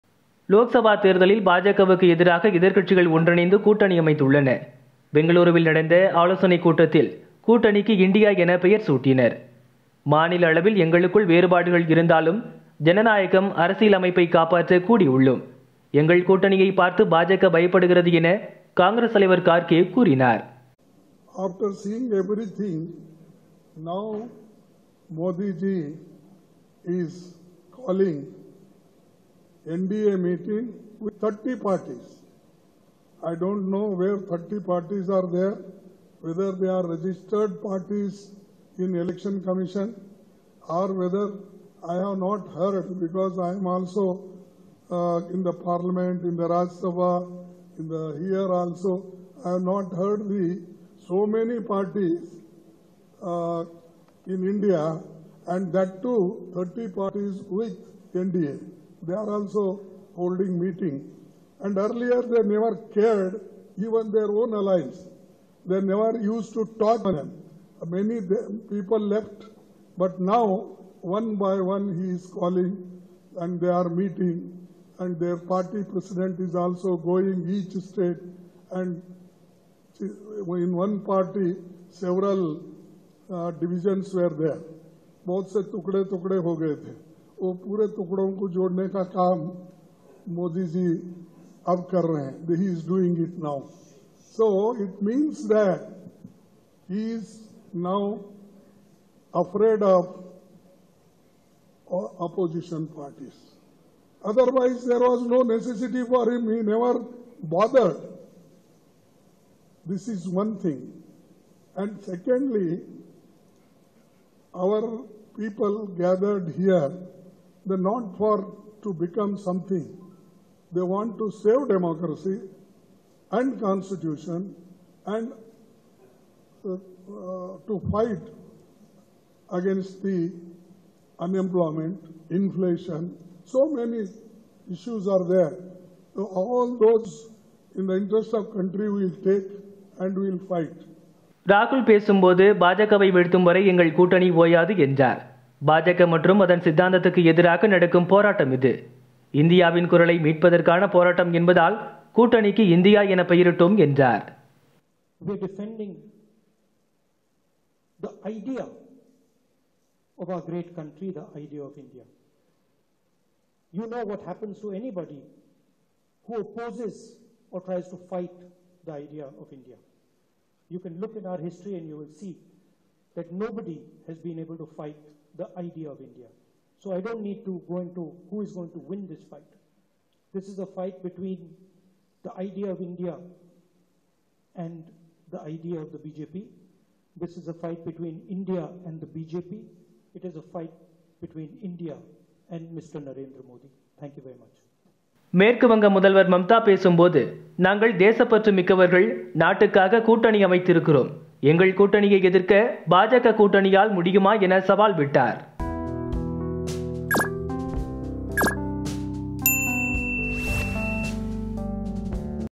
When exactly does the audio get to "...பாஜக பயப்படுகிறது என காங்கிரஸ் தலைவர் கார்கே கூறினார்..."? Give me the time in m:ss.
0:17.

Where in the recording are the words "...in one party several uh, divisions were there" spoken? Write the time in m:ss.
1:20.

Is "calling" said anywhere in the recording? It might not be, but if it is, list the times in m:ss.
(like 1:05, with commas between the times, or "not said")
1:12.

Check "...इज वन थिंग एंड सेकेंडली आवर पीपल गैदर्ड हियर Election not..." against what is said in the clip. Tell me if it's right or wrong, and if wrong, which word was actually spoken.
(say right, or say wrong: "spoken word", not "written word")
wrong: "They", not "Election".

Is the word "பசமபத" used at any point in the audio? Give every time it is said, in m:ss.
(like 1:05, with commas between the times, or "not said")
2:21, 3:16.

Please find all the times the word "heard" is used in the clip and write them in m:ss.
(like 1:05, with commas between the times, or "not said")
0:42, 0:49.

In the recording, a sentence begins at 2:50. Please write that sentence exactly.
You can look in our history and you will see that nobody has been able to fight the idea of India.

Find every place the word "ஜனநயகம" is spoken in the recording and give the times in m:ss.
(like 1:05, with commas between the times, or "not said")
0:12.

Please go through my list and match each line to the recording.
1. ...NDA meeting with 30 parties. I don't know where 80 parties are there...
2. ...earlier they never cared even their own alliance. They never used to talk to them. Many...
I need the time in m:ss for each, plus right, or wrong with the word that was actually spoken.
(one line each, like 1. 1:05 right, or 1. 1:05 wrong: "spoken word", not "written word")
1. 0:29 wrong: "30", not "80"
2. 1:01 right.